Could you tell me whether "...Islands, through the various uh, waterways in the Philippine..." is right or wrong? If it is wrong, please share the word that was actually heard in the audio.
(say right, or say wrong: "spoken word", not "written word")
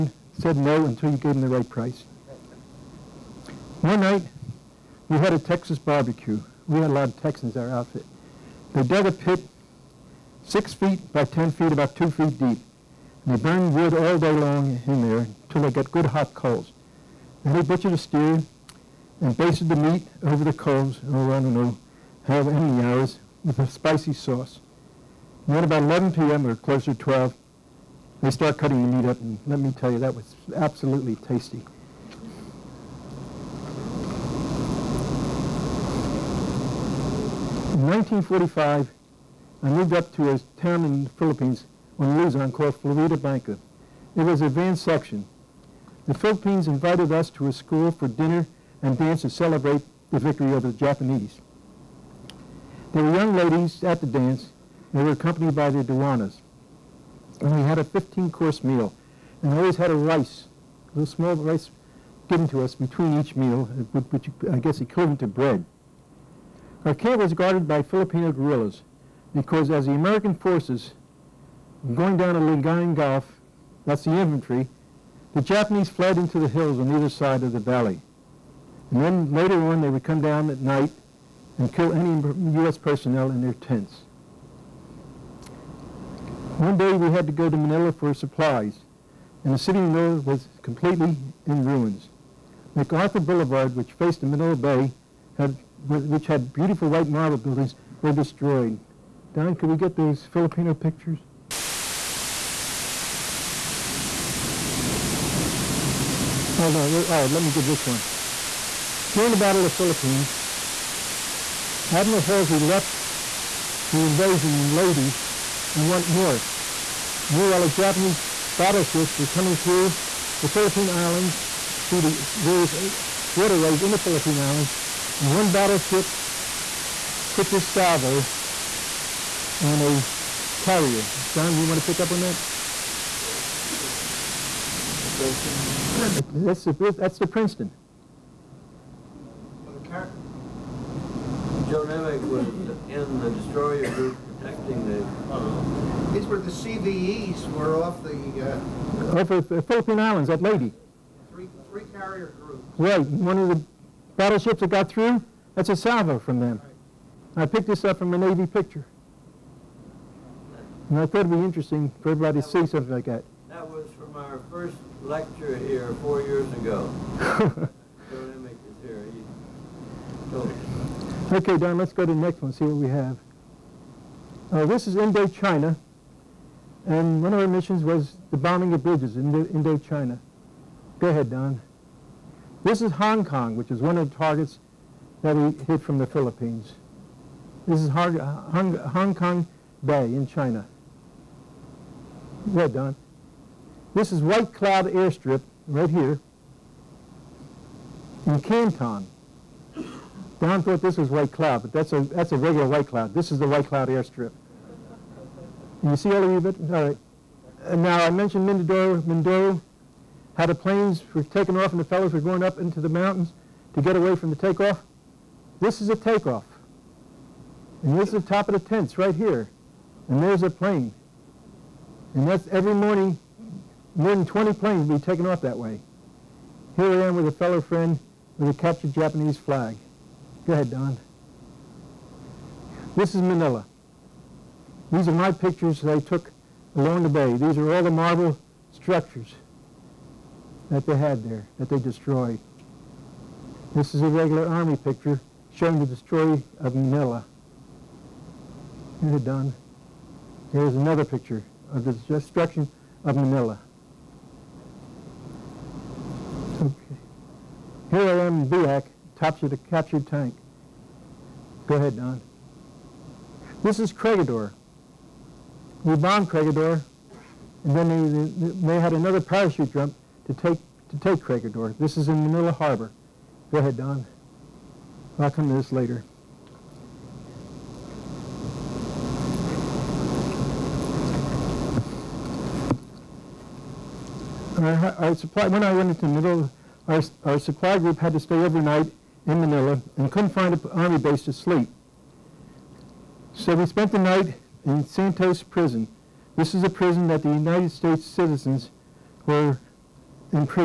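right.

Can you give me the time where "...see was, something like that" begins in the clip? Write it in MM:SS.
02:42.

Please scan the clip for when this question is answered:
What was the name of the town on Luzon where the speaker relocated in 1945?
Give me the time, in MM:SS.
00:42.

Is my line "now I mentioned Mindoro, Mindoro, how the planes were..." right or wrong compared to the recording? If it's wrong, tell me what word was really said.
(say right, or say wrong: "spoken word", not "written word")
right.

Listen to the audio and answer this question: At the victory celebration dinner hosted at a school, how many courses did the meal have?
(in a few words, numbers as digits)
15.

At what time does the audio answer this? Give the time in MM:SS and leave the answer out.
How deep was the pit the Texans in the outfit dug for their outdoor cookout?
00:11.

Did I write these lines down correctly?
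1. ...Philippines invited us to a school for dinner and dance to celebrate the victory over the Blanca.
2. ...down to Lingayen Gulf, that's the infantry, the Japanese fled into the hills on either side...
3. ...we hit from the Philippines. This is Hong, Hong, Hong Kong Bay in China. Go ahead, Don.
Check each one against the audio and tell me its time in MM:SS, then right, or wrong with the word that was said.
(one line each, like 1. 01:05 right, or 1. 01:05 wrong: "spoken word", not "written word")
1. 00:46 wrong: "Japanese", not "Blanca"
2. 01:12 right
3. 03:05 right.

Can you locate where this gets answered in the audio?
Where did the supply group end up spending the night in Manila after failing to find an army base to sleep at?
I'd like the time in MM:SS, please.
04:54.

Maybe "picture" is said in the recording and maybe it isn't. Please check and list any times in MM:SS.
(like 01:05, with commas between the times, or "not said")
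01:40, 02:38, 03:55, 04:04, 04:11.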